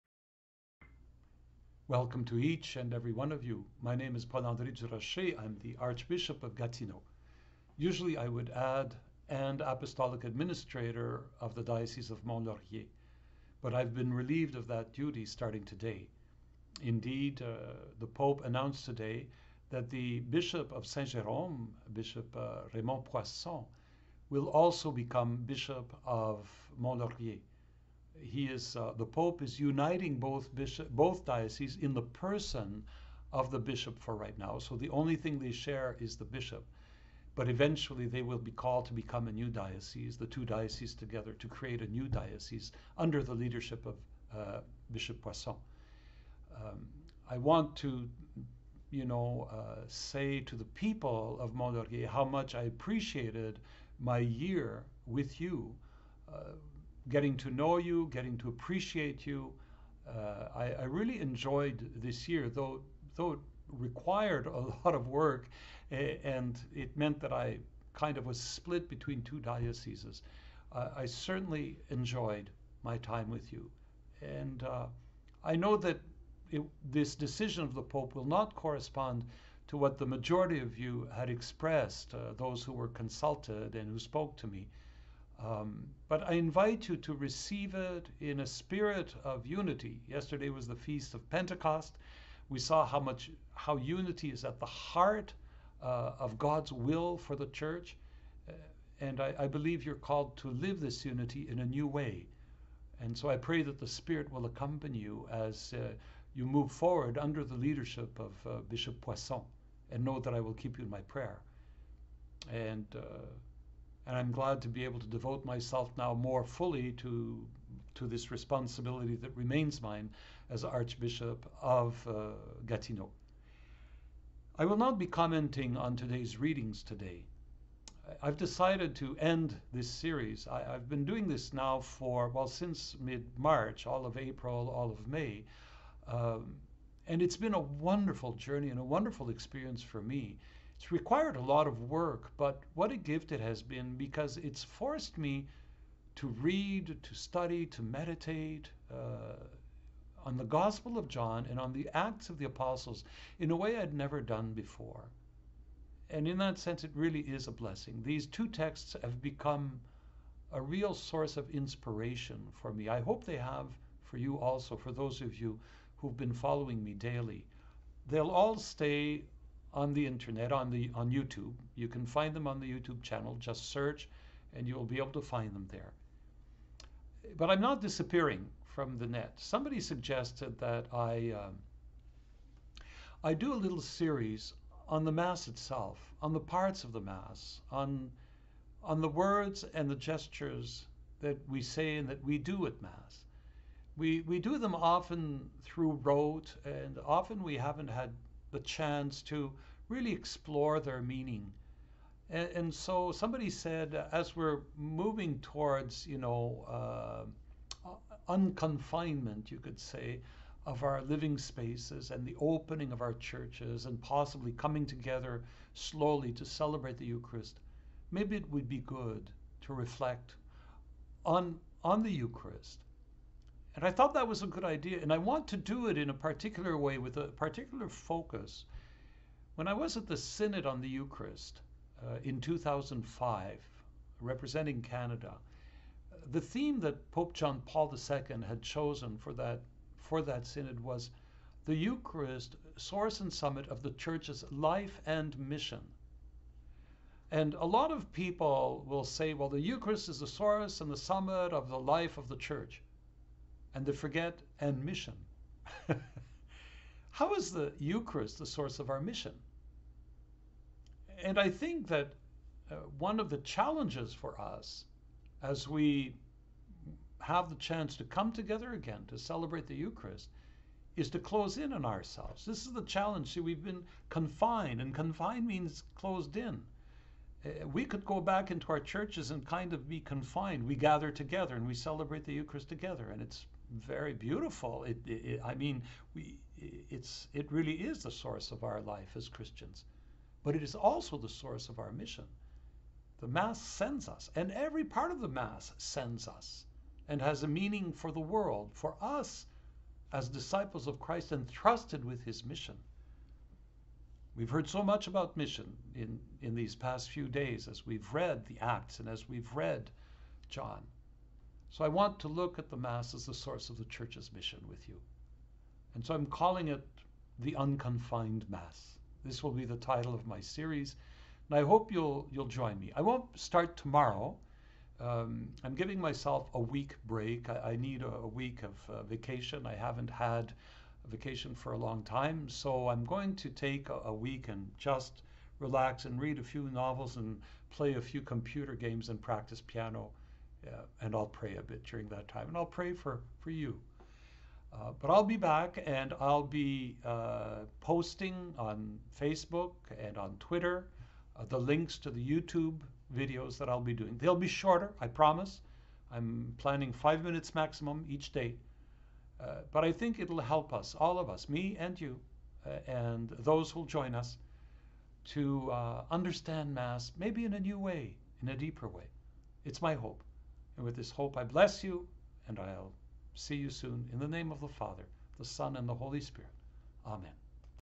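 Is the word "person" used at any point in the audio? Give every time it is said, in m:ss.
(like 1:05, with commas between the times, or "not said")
0:32.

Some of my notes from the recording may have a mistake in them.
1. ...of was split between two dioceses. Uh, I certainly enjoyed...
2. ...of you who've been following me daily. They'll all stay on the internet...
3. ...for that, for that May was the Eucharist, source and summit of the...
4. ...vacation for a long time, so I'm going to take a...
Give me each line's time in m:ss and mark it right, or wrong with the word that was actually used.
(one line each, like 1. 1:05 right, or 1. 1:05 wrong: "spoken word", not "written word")
1. 1:08 right
2. 2:45 right
3. 3:59 wrong: "Synod", not "May"
4. 5:31 right.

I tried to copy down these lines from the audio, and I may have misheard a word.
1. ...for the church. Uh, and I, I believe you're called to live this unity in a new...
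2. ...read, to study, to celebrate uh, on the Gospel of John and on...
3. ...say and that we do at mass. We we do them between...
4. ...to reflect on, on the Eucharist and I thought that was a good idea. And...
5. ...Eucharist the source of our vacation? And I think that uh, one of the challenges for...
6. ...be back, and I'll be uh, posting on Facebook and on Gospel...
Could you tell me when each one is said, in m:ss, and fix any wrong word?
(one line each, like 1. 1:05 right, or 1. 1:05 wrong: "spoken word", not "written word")
1. 1:37 right
2. 2:26 wrong: "meditate", not "celebrate"
3. 3:11 wrong: "often", not "between"
4. 3:39 right
5. 4:17 wrong: "mission", not "vacation"
6. 5:45 wrong: "Twitter", not "Gospel".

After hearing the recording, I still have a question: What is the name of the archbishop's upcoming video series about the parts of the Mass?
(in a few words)
The Unconfined Mass.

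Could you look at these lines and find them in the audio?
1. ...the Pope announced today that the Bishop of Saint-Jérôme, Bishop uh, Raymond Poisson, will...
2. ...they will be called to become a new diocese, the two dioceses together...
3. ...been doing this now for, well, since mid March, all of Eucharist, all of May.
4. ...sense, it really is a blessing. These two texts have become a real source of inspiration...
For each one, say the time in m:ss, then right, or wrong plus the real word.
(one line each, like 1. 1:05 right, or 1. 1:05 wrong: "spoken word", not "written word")
1. 0:17 right
2. 0:38 right
3. 2:10 wrong: "April", not "Eucharist"
4. 2:36 right.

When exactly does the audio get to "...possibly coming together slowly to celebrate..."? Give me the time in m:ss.
3:34.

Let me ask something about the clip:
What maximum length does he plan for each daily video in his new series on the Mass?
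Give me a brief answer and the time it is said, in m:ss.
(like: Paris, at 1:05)
5 minutes, at 5:56.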